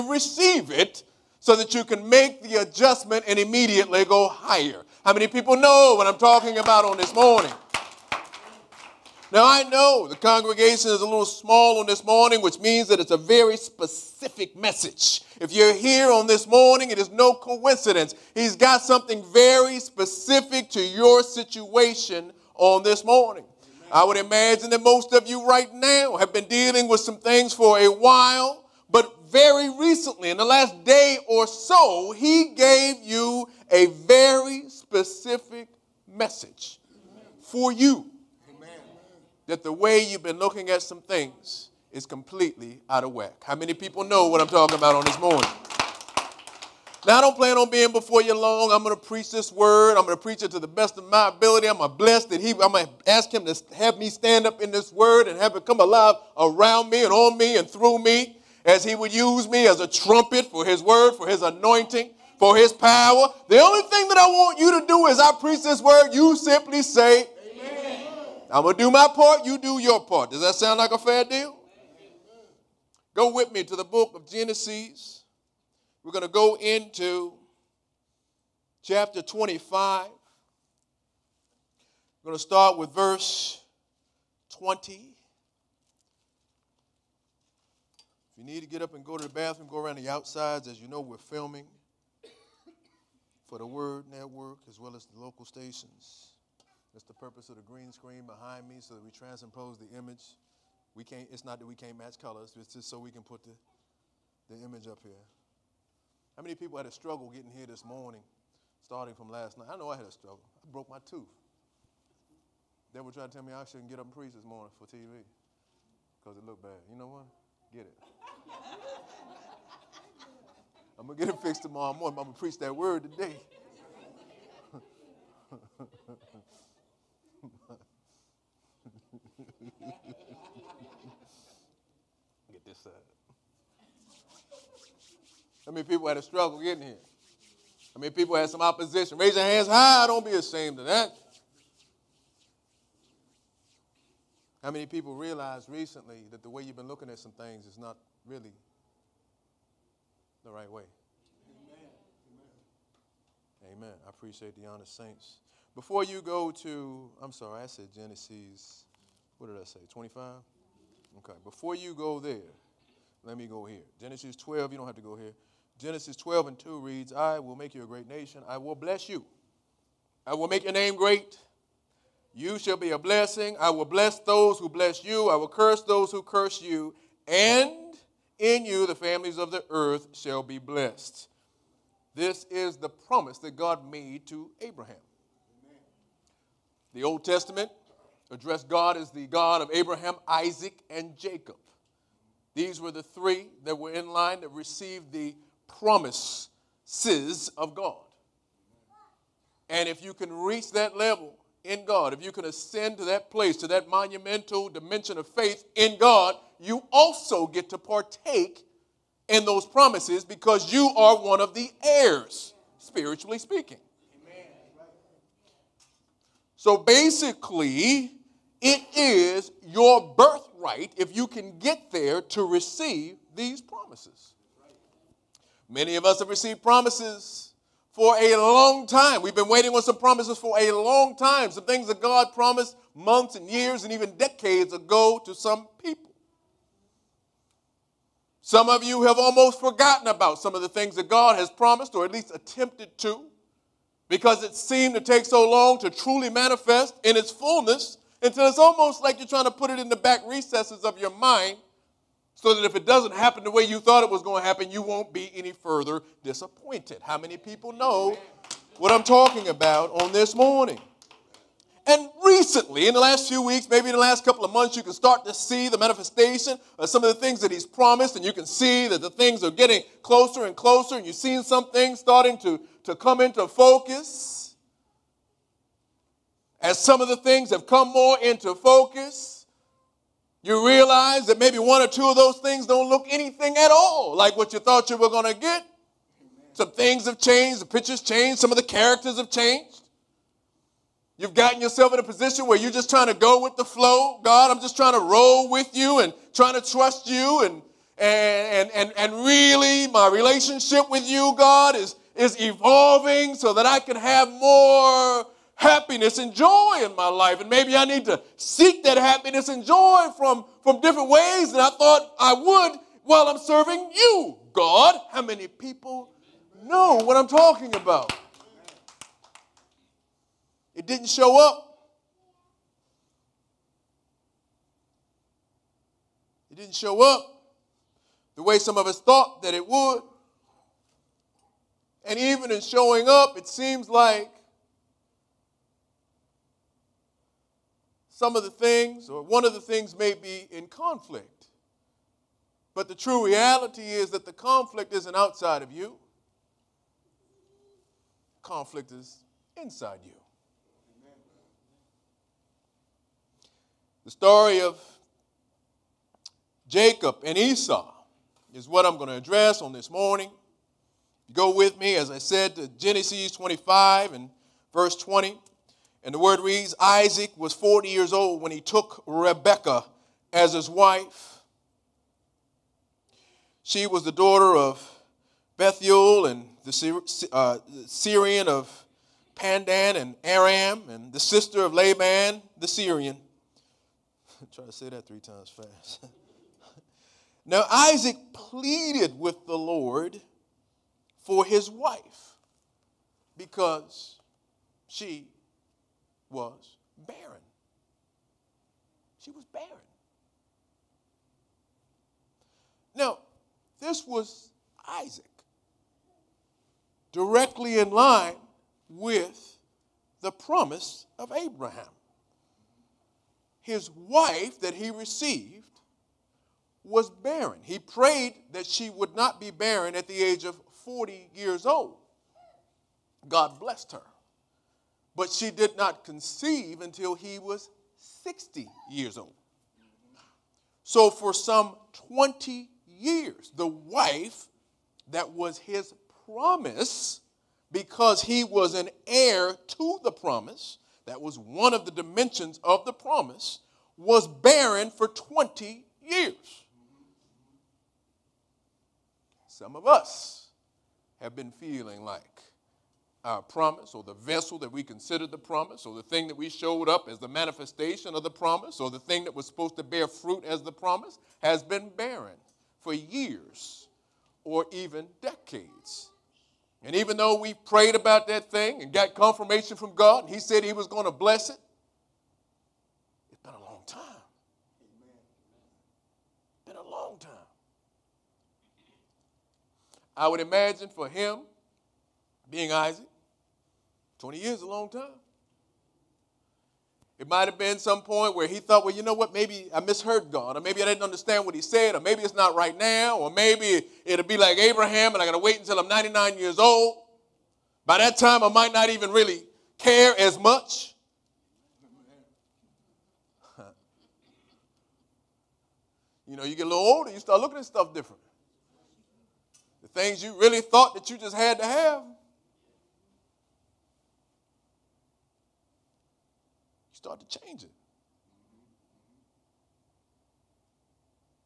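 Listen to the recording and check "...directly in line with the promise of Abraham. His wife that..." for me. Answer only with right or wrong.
right.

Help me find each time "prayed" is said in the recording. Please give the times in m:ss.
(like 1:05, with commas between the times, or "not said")
6:57, 7:47.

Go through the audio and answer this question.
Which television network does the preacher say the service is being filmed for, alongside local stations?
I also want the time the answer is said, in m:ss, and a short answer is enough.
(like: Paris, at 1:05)
Word Network, at 1:33.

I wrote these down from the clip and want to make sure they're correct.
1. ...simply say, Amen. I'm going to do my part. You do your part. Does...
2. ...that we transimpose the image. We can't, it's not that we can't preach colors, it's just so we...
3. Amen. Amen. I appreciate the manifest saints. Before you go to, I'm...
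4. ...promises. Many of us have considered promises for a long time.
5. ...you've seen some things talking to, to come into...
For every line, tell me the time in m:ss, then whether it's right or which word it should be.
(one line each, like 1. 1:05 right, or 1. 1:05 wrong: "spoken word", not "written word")
1. 1:06 right
2. 1:38 wrong: "match", not "preach"
3. 2:33 wrong: "honest", not "manifest"
4. 3:43 wrong: "received", not "considered"
5. 4:31 wrong: "starting", not "talking".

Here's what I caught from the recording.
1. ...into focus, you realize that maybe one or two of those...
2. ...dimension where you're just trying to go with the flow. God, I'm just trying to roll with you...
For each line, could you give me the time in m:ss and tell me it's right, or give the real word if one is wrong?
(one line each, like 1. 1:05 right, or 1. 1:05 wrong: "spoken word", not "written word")
1. 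4:38 right
2. 4:52 wrong: "position", not "dimension".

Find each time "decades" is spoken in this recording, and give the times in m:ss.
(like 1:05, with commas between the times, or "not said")
3:54, 7:45.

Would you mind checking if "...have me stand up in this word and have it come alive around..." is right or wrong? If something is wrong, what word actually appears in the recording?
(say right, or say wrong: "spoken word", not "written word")
right.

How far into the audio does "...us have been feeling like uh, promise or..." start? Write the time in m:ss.
7:29.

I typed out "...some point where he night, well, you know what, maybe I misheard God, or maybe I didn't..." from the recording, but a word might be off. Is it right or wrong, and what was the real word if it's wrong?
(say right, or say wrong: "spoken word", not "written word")
wrong: "thought", not "night".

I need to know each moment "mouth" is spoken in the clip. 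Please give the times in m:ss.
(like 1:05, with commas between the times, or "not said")
not said.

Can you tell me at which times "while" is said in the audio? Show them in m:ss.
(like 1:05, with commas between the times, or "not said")
0:27, 5:13.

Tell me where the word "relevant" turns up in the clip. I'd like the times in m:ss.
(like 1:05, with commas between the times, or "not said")
not said.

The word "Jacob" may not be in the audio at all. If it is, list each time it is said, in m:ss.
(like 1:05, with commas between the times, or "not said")
3:11, 5:56.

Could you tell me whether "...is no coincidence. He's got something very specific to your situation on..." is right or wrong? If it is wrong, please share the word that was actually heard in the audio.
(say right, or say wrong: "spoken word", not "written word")
right.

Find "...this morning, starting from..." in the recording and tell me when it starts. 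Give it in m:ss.
1:47.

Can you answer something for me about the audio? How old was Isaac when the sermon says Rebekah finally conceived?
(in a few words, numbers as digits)
60.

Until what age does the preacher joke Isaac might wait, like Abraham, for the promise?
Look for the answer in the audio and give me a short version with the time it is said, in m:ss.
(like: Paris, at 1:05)
99, at 8:15.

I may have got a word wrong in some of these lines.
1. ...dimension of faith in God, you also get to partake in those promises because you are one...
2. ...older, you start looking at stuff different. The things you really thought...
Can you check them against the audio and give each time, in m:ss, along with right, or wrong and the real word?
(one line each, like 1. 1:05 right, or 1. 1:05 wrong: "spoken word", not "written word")
1. 3:24 right
2. 8:26 right.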